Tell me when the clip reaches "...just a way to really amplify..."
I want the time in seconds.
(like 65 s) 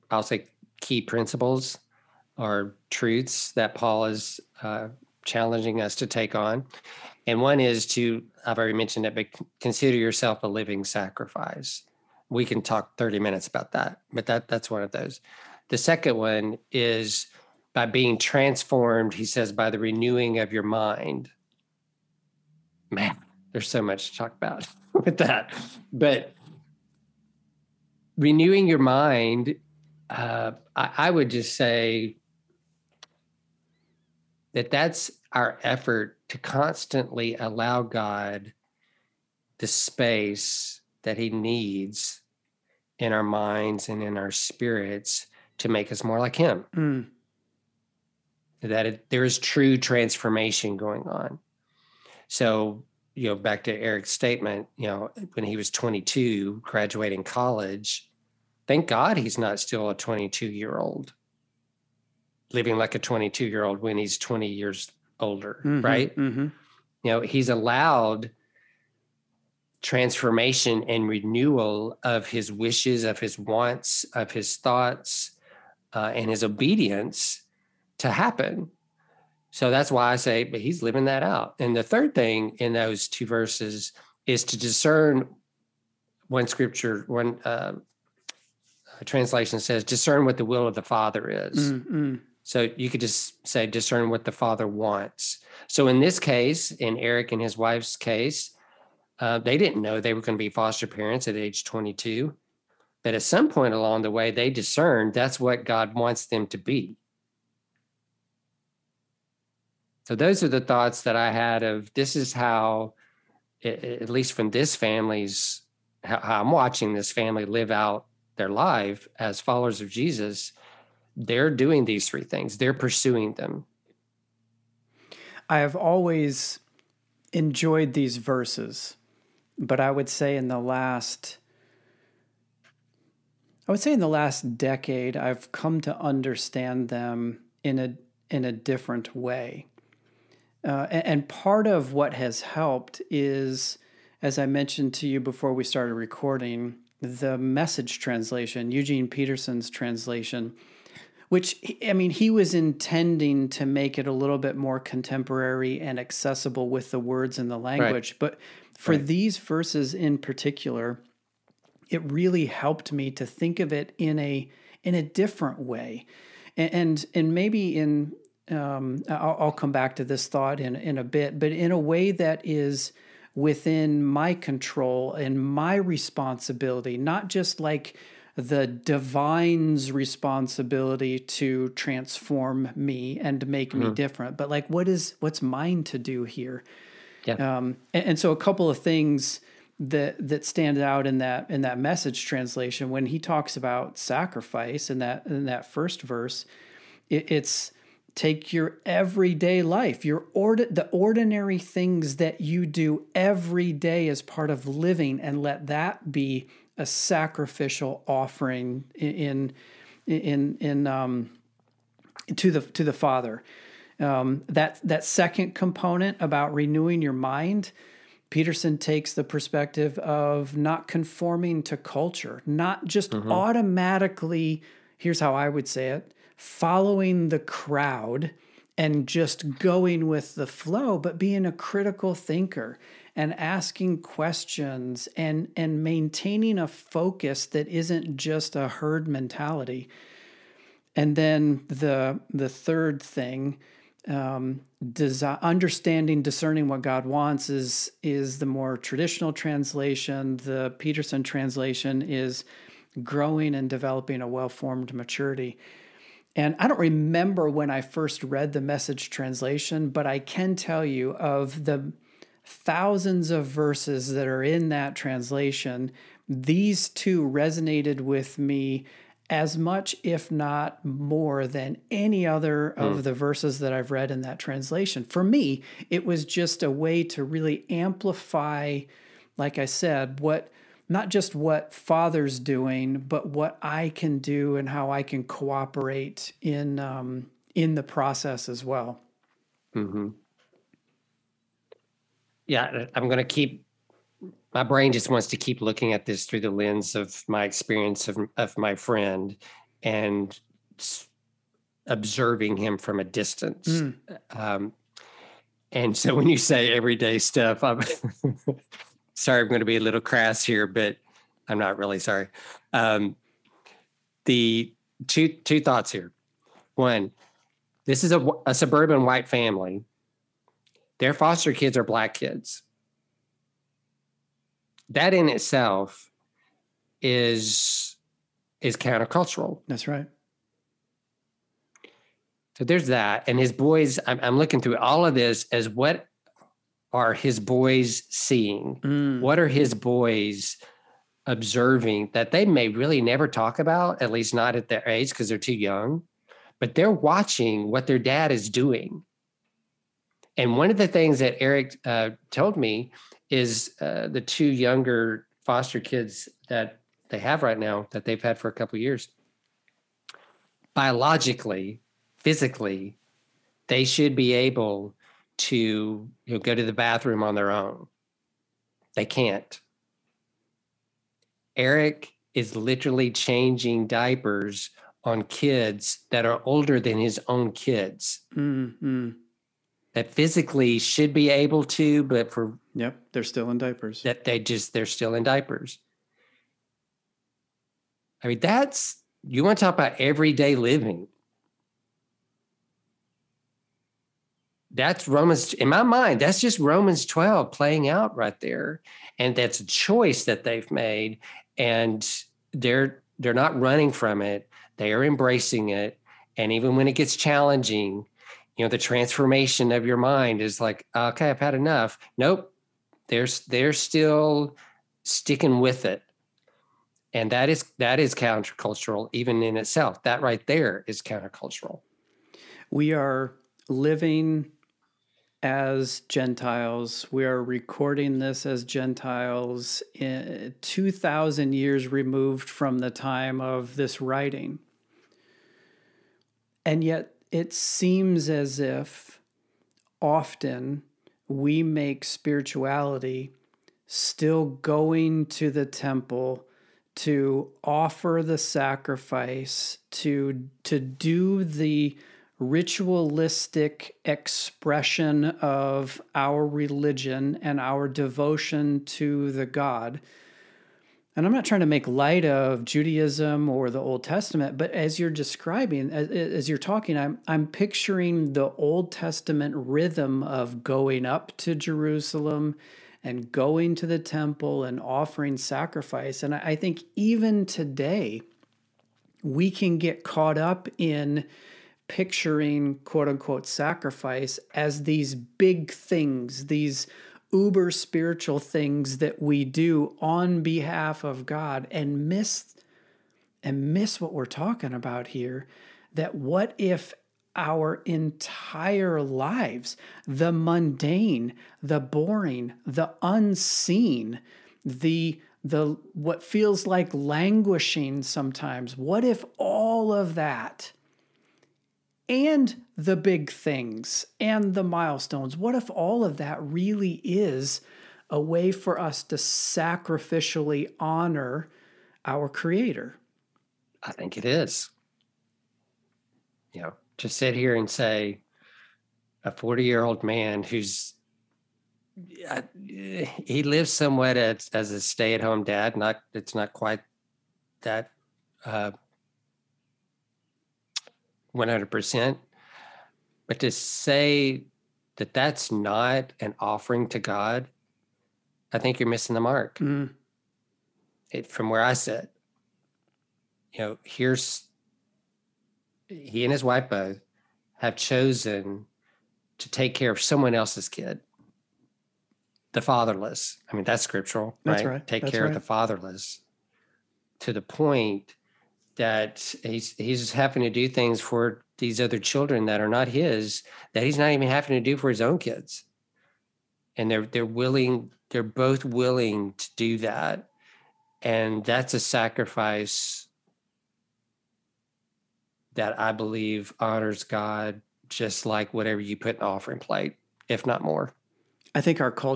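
276 s.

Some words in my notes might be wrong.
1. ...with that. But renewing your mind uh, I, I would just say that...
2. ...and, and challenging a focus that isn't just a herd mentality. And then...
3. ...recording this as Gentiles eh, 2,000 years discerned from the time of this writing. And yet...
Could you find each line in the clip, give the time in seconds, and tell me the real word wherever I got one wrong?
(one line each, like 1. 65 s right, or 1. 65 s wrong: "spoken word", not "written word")
1. 24 s right
2. 235 s wrong: "maintaining", not "challenging"
3. 427 s wrong: "removed", not "discerned".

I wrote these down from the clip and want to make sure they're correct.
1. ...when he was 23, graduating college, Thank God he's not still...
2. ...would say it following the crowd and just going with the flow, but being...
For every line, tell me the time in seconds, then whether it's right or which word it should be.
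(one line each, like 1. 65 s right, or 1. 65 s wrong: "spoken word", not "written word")
1. 55 s wrong: "22", not "23"
2. 225 s right.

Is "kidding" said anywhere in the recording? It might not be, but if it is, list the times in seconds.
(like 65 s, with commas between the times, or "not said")
not said.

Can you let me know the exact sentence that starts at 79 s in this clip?
So that's why I say, but he's living that out.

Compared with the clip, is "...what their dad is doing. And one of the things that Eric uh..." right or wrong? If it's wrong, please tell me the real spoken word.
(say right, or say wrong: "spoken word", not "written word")
right.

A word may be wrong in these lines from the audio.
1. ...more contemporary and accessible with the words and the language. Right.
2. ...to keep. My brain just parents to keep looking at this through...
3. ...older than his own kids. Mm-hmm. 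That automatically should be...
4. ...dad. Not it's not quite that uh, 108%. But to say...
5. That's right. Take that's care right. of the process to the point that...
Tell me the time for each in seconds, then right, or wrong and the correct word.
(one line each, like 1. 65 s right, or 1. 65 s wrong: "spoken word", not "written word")
1. 154 s right
2. 293 s wrong: "wants", not "parents"
3. 376 s wrong: "physically", not "automatically"
4. 535 s wrong: "100", not "108"
5. 564 s wrong: "fatherless", not "process".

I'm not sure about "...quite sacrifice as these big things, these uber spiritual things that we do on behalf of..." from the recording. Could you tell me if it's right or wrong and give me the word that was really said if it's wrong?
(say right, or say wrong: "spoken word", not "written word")
wrong: "unquote", not "quite".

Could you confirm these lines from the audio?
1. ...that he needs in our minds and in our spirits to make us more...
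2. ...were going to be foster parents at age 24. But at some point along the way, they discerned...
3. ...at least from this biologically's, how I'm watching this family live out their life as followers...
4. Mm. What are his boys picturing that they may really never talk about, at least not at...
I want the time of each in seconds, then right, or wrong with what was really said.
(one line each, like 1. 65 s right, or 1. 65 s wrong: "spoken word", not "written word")
1. 41 s right
2. 100 s wrong: "22", not "24"
3. 113 s wrong: "family", not "biologically"
4. 338 s wrong: "observing", not "picturing".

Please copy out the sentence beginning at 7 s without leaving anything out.
And one is to, I've already mentioned it, but consider yourself a living sacrifice.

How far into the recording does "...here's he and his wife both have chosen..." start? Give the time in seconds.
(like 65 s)
553 s.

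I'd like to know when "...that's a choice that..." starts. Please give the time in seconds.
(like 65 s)
399 s.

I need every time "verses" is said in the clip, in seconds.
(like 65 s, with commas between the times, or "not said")
83 s, 128 s, 159 s, 196 s, 263 s, 273 s.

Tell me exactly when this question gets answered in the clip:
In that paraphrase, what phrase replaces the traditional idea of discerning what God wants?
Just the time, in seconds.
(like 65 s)
254 s.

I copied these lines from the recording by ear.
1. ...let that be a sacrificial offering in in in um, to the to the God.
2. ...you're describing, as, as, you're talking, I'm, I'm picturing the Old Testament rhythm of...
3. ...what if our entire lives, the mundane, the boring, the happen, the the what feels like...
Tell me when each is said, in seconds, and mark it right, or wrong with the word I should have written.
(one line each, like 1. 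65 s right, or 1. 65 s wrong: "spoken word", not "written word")
1. 205 s wrong: "Father", not "God"
2. 464 s right
3. 496 s wrong: "unseen", not "happen".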